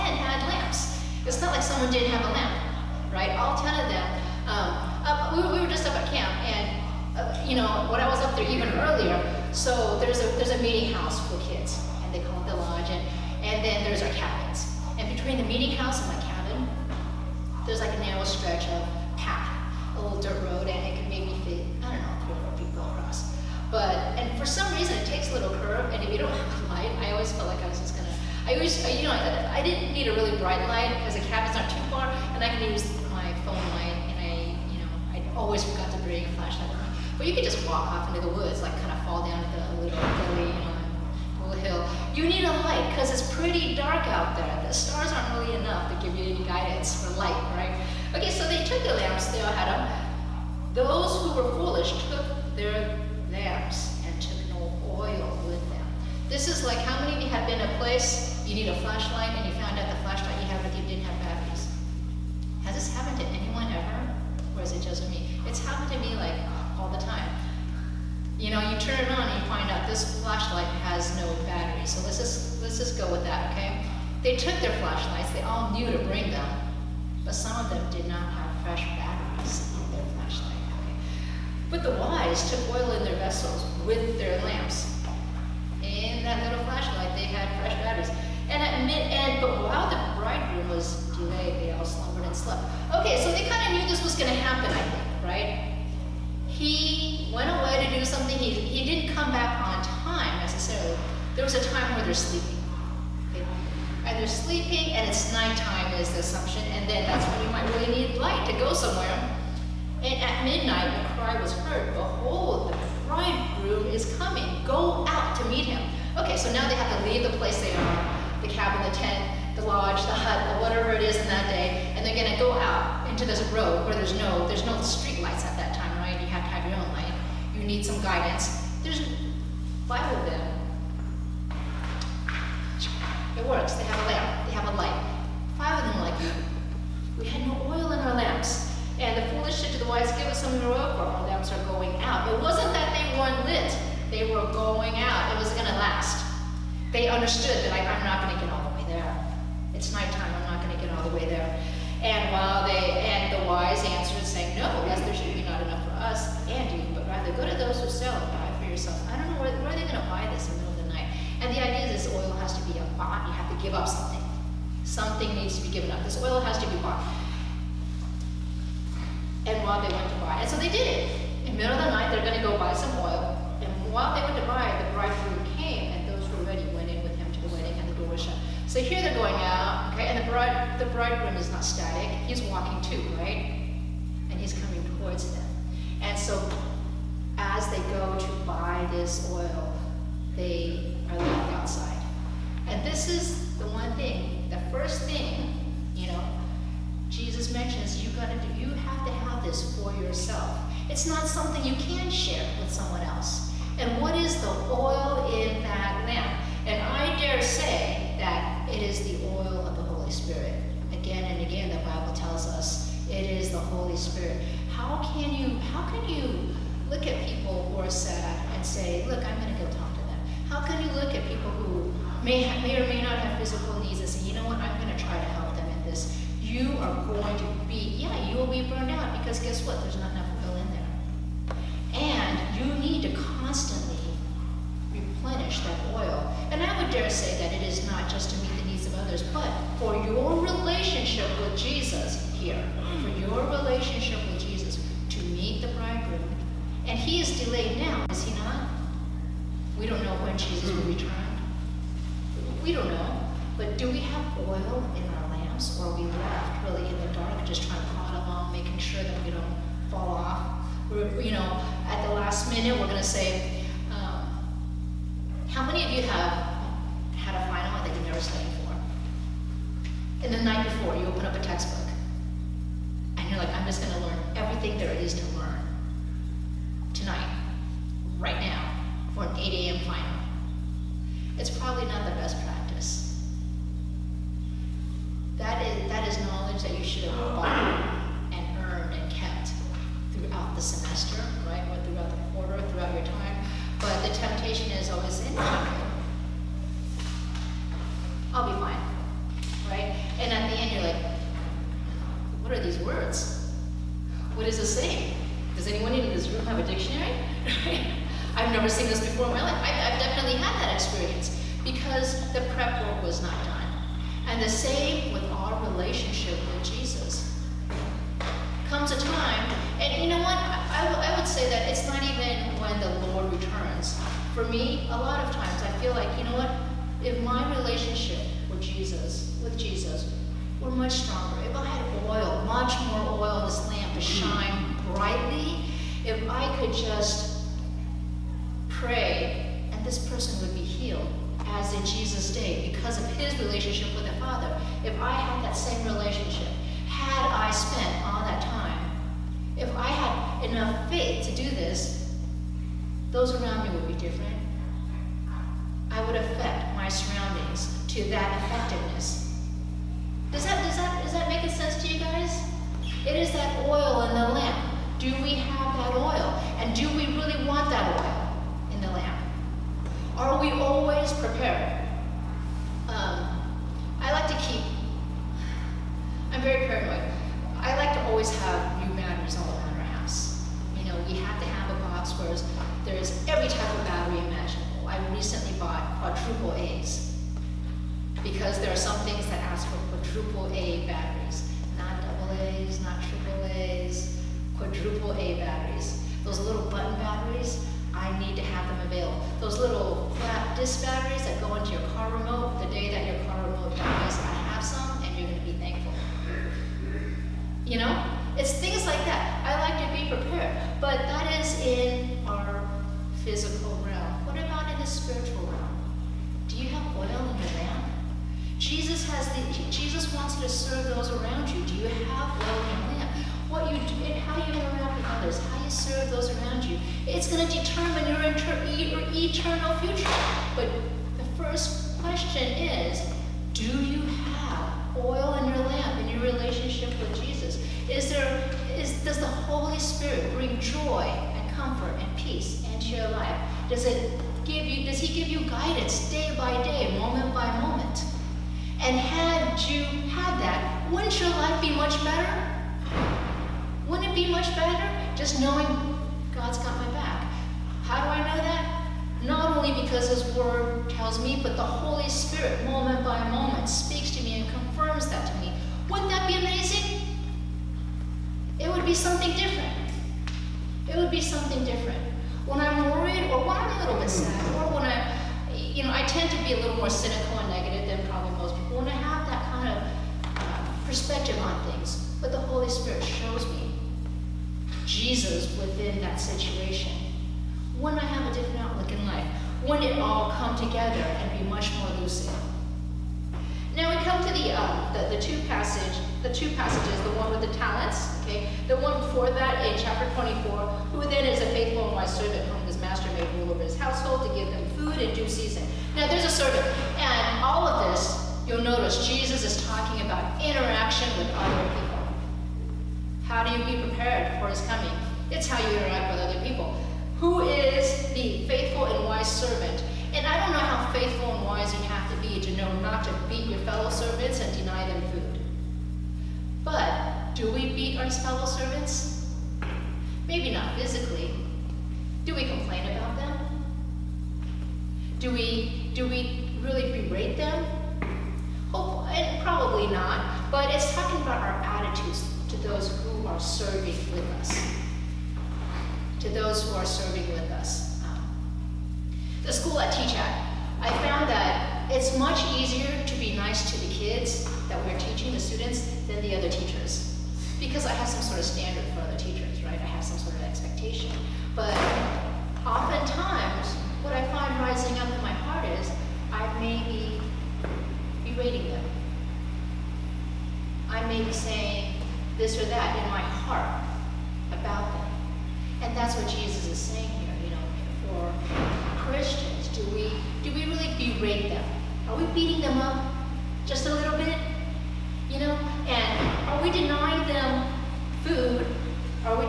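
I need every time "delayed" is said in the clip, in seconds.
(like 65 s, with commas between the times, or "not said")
91 s, 247 s.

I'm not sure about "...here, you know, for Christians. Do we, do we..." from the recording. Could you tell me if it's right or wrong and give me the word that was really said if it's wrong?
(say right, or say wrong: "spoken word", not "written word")
right.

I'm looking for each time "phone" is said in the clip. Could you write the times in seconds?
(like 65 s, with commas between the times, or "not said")
33 s.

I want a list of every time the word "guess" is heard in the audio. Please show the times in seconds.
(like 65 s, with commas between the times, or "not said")
229 s.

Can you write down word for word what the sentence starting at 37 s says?
But you could just walk off into the woods, like kind of fall down the little gully, you know, little hill.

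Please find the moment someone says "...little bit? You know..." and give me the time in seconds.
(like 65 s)
583 s.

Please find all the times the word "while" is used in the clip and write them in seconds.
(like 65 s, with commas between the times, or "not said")
89 s, 152 s, 169 s, 173 s.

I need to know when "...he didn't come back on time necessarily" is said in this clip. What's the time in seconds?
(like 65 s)
98 s.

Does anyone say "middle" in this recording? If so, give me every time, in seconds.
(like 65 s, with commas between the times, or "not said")
160 s, 171 s.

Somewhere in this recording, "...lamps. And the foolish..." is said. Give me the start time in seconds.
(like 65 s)
138 s.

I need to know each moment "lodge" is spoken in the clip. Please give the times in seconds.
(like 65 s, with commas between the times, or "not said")
12 s, 119 s.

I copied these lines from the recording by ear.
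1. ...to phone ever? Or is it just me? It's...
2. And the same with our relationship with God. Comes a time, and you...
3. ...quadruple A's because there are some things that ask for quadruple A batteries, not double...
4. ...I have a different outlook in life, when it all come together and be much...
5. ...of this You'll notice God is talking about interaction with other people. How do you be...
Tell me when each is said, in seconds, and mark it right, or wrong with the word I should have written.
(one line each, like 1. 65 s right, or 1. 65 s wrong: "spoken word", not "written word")
1. 63 s wrong: "anyone", not "phone"
2. 314 s wrong: "Jesus", not "God"
3. 385 s right
4. 487 s right
5. 507 s wrong: "Jesus", not "God".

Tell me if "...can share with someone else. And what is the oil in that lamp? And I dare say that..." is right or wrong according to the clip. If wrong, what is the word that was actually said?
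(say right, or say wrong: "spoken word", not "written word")
right.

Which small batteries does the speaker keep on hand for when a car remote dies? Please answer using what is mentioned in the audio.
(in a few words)
flat disc batteries.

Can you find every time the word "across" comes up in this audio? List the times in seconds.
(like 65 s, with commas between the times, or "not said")
22 s.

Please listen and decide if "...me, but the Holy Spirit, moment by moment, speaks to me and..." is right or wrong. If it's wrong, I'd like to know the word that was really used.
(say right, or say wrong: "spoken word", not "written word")
right.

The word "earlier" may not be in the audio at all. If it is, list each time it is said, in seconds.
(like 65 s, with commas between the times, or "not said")
8 s.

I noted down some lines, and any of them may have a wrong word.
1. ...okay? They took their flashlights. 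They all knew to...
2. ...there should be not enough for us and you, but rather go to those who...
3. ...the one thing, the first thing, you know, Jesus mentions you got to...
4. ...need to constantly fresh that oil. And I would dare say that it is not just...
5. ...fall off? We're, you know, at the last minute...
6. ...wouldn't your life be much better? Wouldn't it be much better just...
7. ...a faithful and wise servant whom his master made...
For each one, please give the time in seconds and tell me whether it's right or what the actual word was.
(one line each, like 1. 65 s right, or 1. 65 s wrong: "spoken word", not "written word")
1. 73 s right
2. 155 s right
3. 193 s right
4. 232 s wrong: "replenish", not "fresh"
5. 259 s right
6. 450 s right
7. 501 s right.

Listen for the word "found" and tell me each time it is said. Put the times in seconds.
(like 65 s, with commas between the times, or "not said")
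59 s, 551 s.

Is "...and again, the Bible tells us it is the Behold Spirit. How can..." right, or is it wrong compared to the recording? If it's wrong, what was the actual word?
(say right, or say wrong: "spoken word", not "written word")
wrong: "Holy", not "Behold".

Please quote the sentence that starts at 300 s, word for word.
And at the end, you're like, what are these words?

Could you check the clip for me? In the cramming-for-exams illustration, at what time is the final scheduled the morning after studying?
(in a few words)
8 a.m.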